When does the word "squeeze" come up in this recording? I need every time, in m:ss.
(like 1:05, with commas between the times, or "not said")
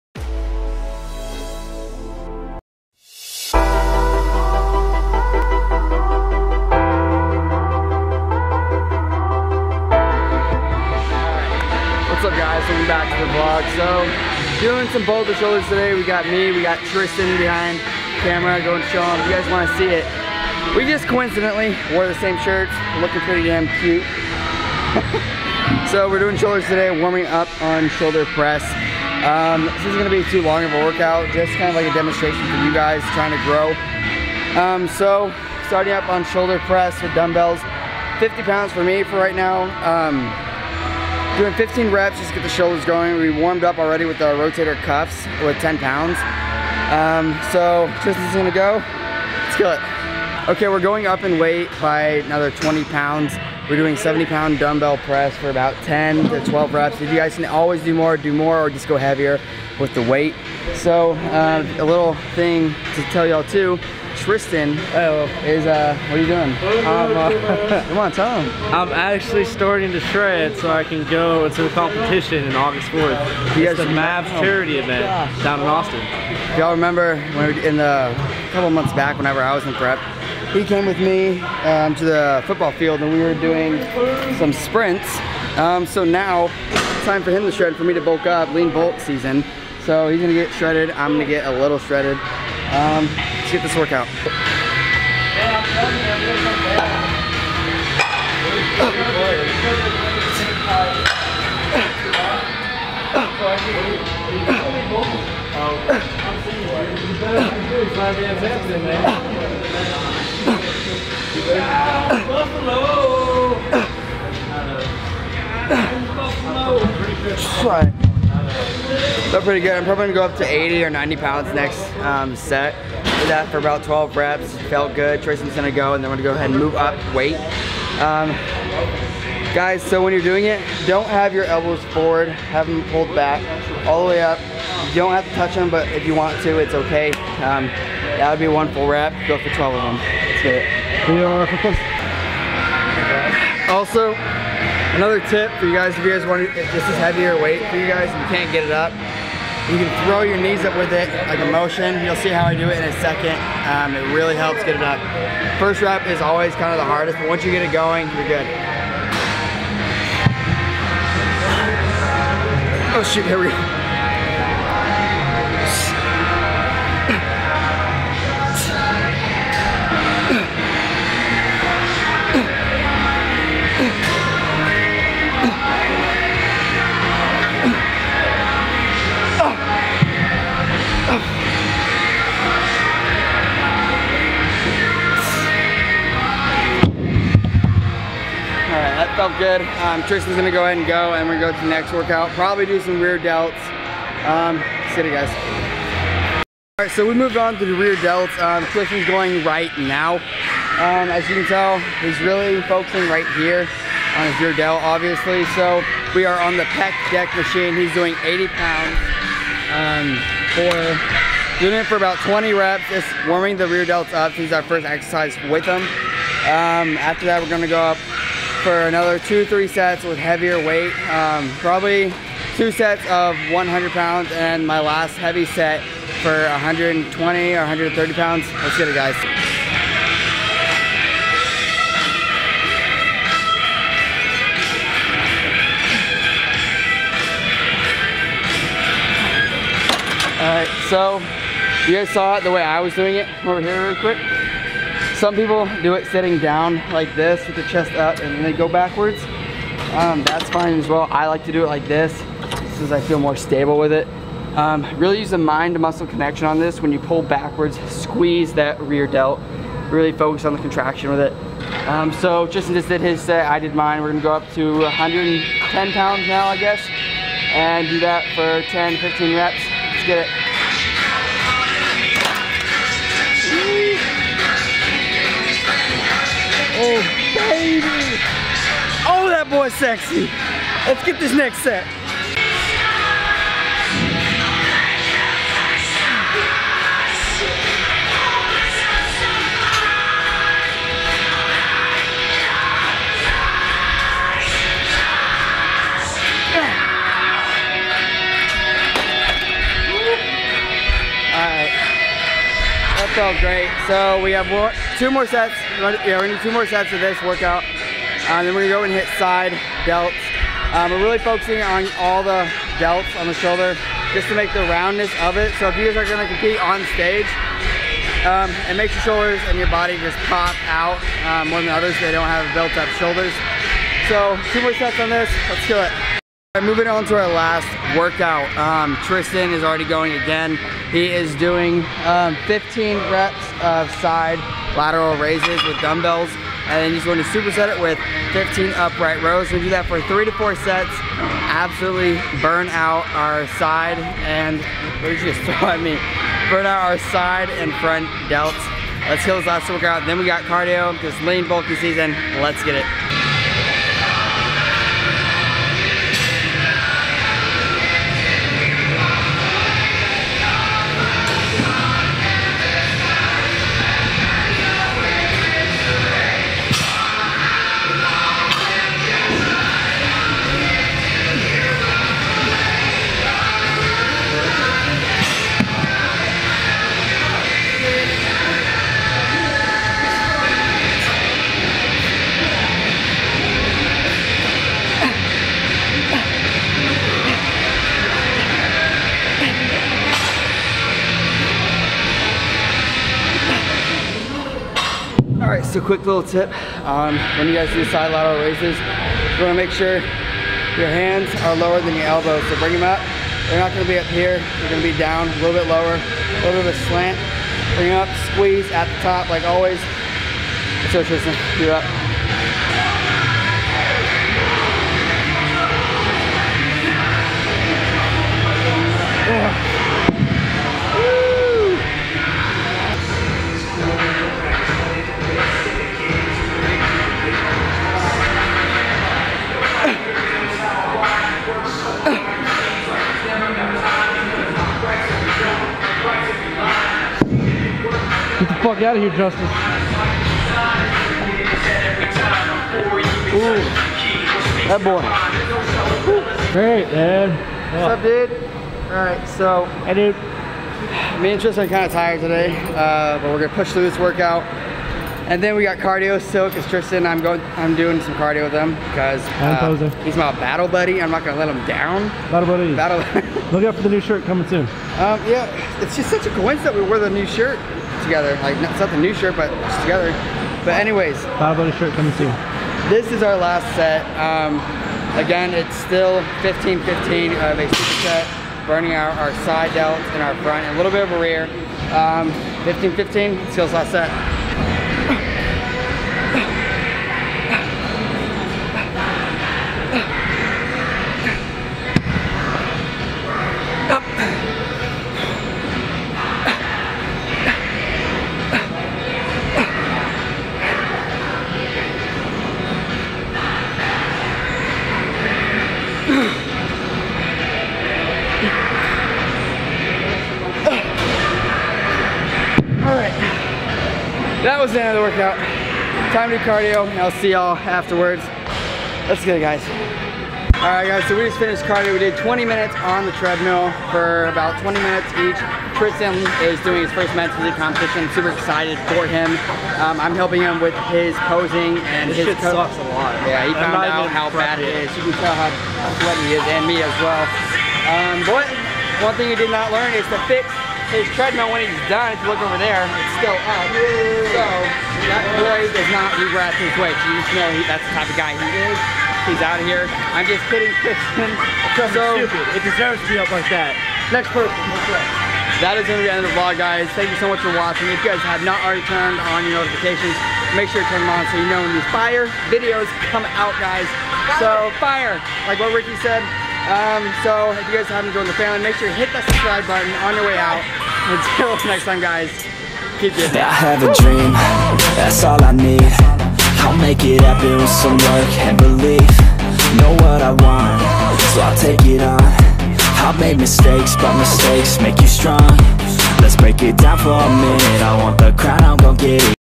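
4:17, 6:48.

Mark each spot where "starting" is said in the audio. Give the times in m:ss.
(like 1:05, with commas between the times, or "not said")
0:35, 1:09.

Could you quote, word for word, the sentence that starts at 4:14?
Um, really use the mind muscle connection on this.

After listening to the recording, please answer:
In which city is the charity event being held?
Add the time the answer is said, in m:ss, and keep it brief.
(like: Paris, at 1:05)
Austin, at 1:15.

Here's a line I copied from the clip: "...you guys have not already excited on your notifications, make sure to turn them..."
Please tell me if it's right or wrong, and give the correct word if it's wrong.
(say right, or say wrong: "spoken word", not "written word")
wrong: "turned", not "excited".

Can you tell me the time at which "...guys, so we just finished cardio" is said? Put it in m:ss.
8:40.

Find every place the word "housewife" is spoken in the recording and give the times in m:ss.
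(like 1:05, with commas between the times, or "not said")
not said.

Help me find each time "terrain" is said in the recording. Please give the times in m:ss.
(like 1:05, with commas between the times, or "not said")
not said.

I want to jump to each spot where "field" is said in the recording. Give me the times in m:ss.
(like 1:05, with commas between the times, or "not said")
1:22.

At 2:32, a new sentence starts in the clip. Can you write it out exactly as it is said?
You'll see how I do it in a second.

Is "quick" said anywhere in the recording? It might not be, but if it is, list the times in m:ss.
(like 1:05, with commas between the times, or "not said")
4:03, 6:35.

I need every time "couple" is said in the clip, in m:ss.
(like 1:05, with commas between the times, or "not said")
1:18.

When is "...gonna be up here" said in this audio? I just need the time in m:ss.
6:43.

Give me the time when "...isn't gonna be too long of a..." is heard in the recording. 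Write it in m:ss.
0:29.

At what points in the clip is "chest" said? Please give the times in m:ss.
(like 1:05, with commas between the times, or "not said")
4:07.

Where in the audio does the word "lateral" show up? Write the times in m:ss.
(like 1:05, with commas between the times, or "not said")
5:34, 6:38.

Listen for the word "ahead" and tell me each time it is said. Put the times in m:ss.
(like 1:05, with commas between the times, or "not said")
2:06, 3:10.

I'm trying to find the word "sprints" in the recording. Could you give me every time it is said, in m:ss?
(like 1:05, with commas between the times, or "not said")
1:24.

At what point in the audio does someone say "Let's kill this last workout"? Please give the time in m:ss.
5:49.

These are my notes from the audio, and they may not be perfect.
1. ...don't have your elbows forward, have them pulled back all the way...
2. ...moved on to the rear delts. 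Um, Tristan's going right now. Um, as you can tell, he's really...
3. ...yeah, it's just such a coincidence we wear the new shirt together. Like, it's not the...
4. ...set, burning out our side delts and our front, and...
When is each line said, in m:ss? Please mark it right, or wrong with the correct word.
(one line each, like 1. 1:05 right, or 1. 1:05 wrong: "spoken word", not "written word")
1. 2:10 right
2. 3:17 right
3. 7:45 right
4. 7:58 right.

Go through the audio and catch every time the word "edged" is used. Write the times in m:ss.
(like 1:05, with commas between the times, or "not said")
not said.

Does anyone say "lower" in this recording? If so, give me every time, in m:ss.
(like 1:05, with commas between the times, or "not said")
6:41, 6:45.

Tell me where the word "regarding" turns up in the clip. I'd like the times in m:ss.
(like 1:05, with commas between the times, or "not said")
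not said.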